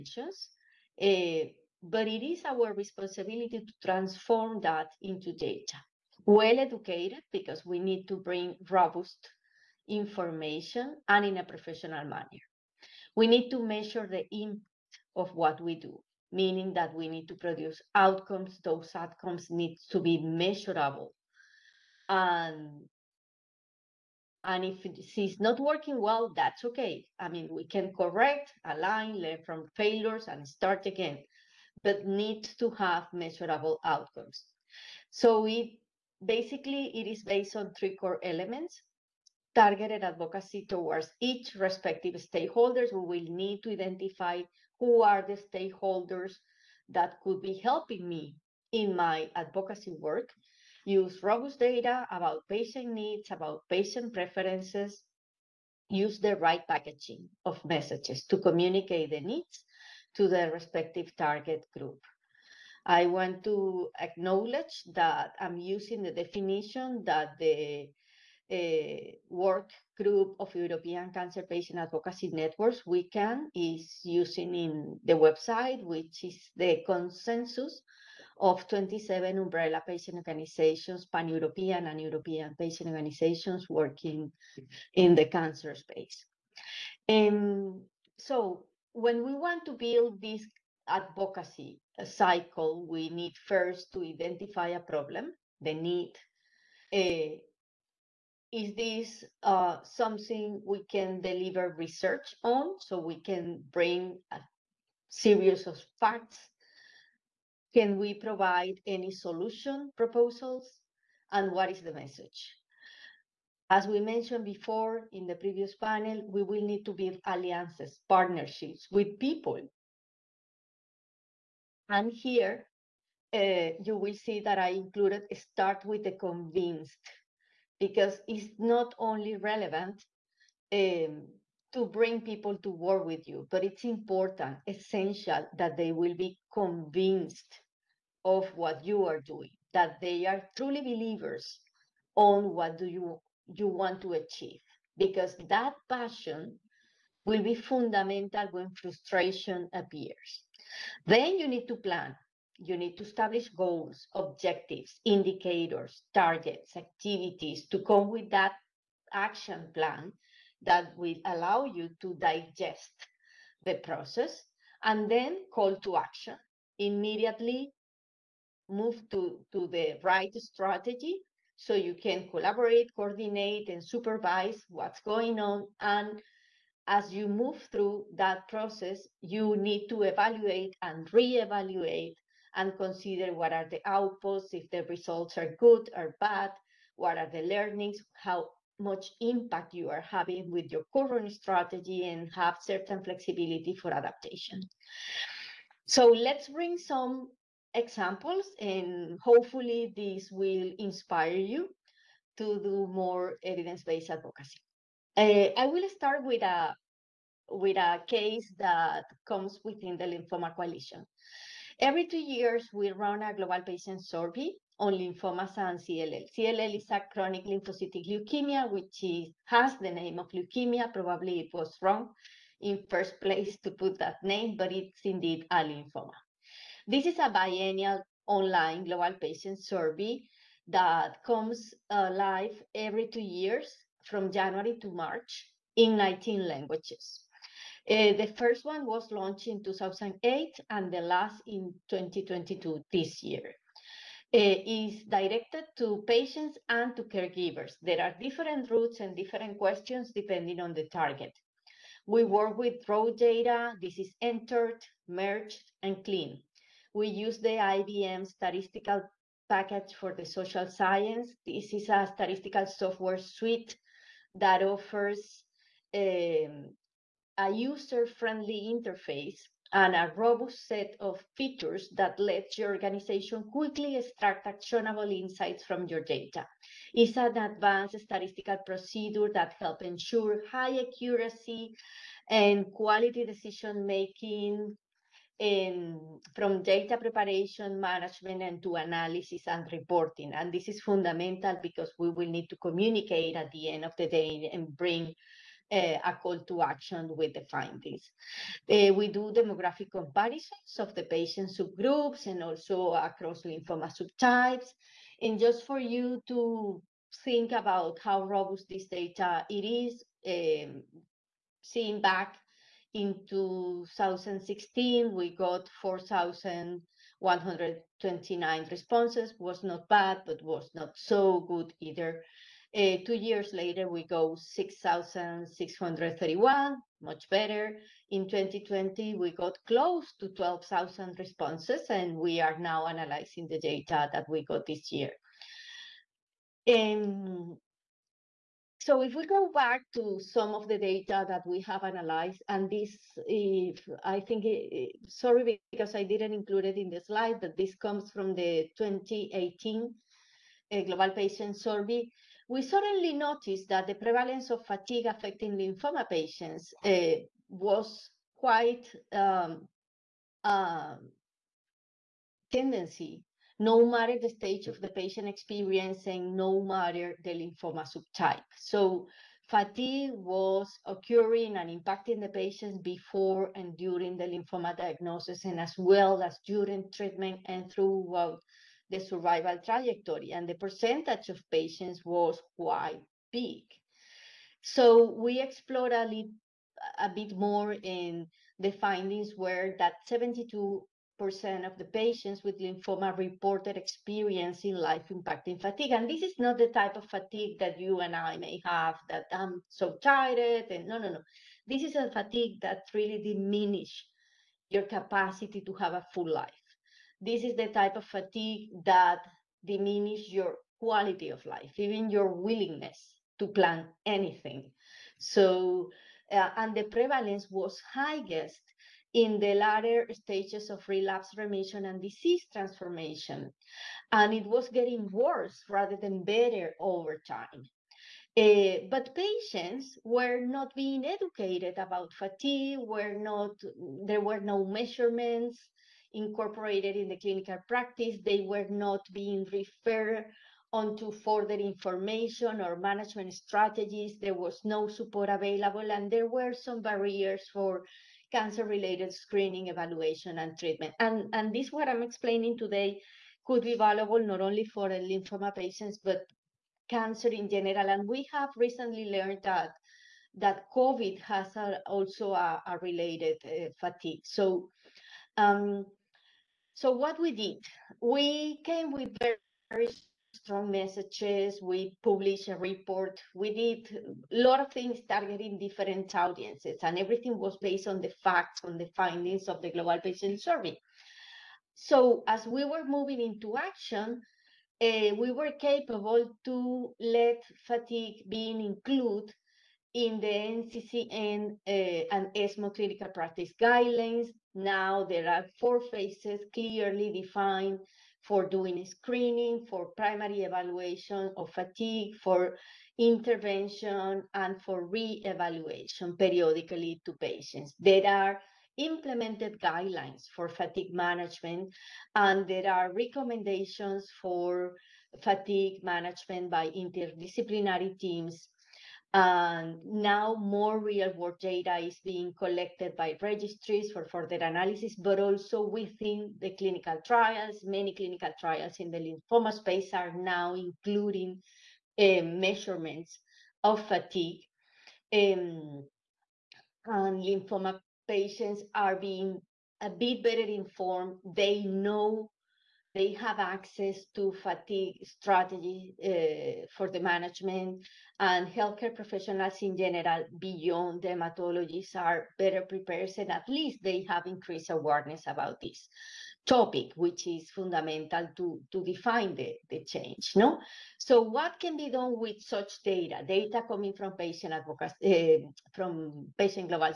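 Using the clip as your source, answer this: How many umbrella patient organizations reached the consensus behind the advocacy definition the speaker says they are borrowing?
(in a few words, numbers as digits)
27.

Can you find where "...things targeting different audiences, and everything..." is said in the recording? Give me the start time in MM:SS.
07:54.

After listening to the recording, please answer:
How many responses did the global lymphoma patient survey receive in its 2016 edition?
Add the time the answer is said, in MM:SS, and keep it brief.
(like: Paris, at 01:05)
4,129, at 05:15.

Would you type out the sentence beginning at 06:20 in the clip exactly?
And the percentage of patients was quite big.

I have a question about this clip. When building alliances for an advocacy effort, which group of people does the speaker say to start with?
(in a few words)
the convinced.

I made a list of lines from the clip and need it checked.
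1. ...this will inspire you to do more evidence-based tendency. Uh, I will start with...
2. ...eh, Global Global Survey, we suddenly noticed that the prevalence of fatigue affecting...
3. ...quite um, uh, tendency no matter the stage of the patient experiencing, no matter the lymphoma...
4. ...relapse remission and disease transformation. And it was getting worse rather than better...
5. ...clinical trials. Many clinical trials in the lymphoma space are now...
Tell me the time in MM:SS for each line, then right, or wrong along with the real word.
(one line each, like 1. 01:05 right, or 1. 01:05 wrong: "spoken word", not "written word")
1. 03:19 wrong: "advocacy", not "tendency"
2. 05:50 wrong: "Patient", not "Global"
3. 05:58 right
4. 07:00 right
5. 08:46 right.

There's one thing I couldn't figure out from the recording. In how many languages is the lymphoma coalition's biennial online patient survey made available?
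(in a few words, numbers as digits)
19.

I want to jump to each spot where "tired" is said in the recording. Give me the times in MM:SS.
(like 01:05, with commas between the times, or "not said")
06:39.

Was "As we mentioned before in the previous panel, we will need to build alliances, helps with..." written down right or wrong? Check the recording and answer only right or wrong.
wrong.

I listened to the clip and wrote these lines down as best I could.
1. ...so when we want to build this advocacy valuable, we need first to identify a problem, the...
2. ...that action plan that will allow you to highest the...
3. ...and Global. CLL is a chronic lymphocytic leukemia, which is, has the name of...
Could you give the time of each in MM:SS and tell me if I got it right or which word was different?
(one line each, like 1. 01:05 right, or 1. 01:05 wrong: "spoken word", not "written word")
1. 01:28 wrong: "cycle", not "valuable"
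2. 02:38 wrong: "digest", not "highest"
3. 03:35 wrong: "CLL", not "Global".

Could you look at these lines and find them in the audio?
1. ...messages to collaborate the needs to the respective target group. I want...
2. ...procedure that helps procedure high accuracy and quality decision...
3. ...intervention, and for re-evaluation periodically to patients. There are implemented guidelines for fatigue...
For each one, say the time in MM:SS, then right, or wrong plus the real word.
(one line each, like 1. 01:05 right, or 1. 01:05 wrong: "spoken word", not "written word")
1. 00:57 wrong: "communicate", not "collaborate"
2. 04:38 wrong: "ensure", not "procedure"
3. 08:22 right.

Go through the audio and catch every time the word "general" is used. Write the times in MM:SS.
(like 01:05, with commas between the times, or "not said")
07:37, 09:09.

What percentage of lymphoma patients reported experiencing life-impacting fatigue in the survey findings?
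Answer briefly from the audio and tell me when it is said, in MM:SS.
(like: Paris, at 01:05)
72%, at 06:30.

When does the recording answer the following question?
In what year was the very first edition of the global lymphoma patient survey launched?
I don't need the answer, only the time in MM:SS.
03:59.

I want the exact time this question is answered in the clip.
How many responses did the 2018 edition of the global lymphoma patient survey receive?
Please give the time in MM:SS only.
05:24.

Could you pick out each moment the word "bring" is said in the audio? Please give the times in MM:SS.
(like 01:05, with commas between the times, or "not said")
00:08, 01:43, 02:11, 03:16, 04:54.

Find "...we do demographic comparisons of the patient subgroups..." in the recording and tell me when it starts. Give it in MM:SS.
04:58.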